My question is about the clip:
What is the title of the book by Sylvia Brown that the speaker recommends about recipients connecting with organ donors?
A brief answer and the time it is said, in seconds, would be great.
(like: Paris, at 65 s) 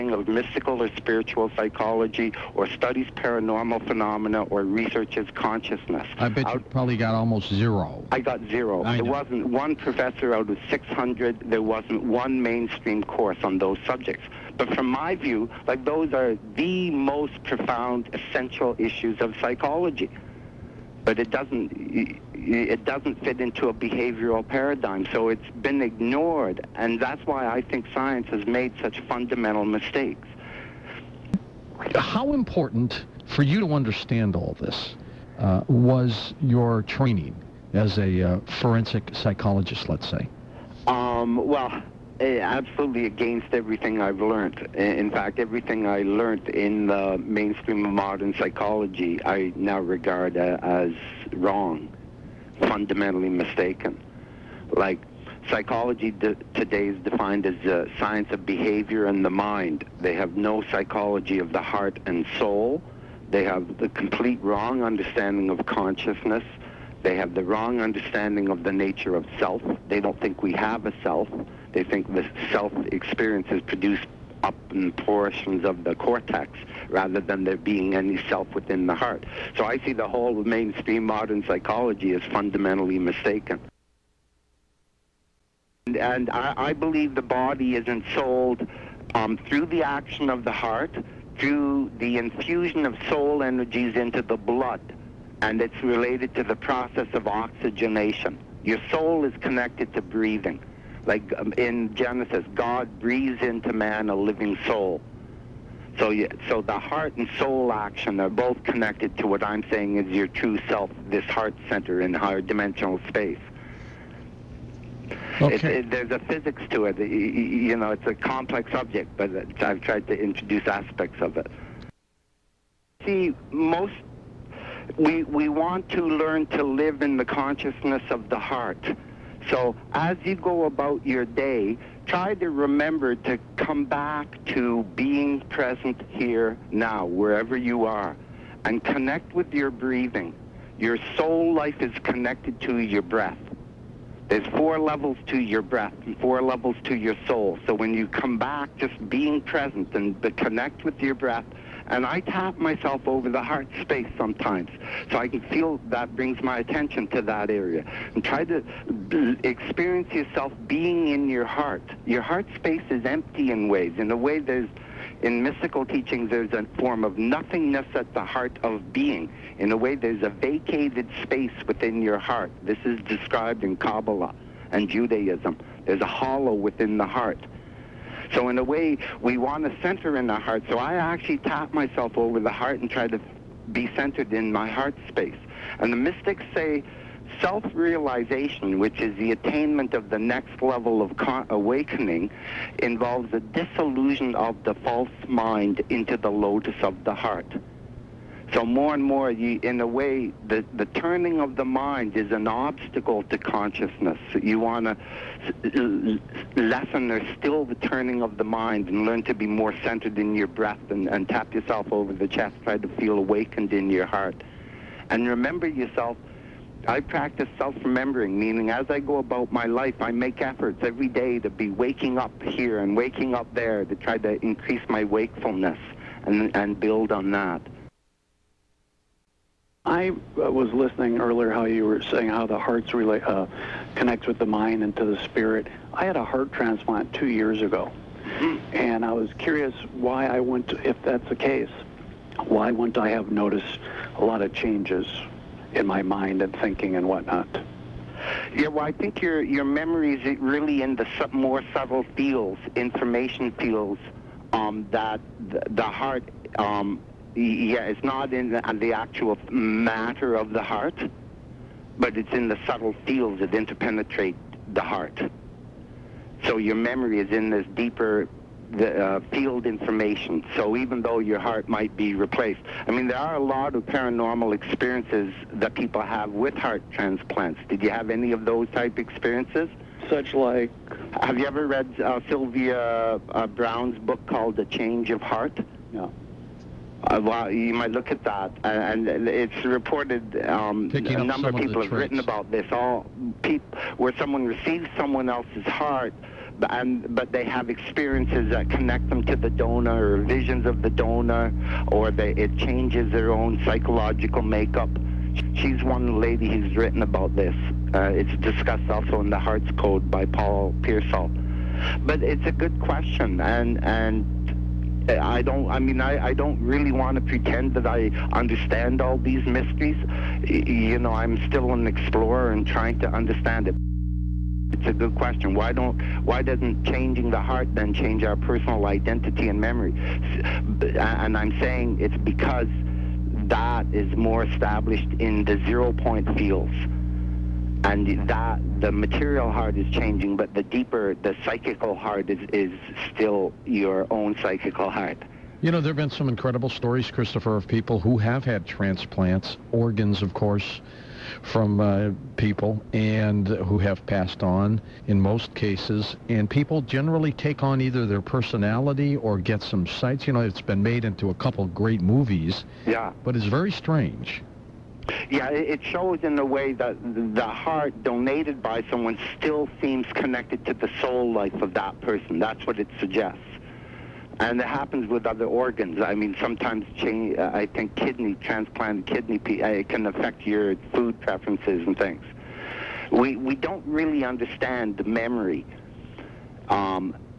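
The Change of Heart, at 284 s.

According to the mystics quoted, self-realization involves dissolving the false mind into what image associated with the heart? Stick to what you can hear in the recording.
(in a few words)
the lotus of the heart.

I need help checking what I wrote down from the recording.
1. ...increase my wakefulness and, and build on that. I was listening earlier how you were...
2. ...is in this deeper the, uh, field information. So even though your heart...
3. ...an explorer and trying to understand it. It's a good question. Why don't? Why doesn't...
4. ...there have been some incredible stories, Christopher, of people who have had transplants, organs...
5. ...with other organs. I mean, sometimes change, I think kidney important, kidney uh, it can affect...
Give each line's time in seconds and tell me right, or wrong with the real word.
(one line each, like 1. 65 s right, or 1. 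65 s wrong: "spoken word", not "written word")
1. 224 s right
2. 267 s right
3. 321 s right
4. 345 s right
5. 375 s wrong: "transplant", not "important".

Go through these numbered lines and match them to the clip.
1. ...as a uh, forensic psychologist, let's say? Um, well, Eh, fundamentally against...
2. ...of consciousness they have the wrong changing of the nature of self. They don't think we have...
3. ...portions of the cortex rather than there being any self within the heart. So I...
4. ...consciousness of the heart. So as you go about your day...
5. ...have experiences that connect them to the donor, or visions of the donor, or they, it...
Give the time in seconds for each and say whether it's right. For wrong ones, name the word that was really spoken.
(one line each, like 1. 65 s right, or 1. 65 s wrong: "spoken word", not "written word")
1. 37 s wrong: "absolutely", not "fundamentally"
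2. 65 s wrong: "understanding", not "changing"
3. 74 s right
4. 127 s right
5. 297 s right.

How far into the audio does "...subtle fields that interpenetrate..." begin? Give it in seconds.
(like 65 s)
262 s.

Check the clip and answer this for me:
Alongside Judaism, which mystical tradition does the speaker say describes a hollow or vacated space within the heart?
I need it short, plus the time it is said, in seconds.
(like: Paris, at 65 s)
Kabbalah, at 173 s.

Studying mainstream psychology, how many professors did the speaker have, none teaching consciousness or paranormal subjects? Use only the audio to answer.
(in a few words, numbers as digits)
600.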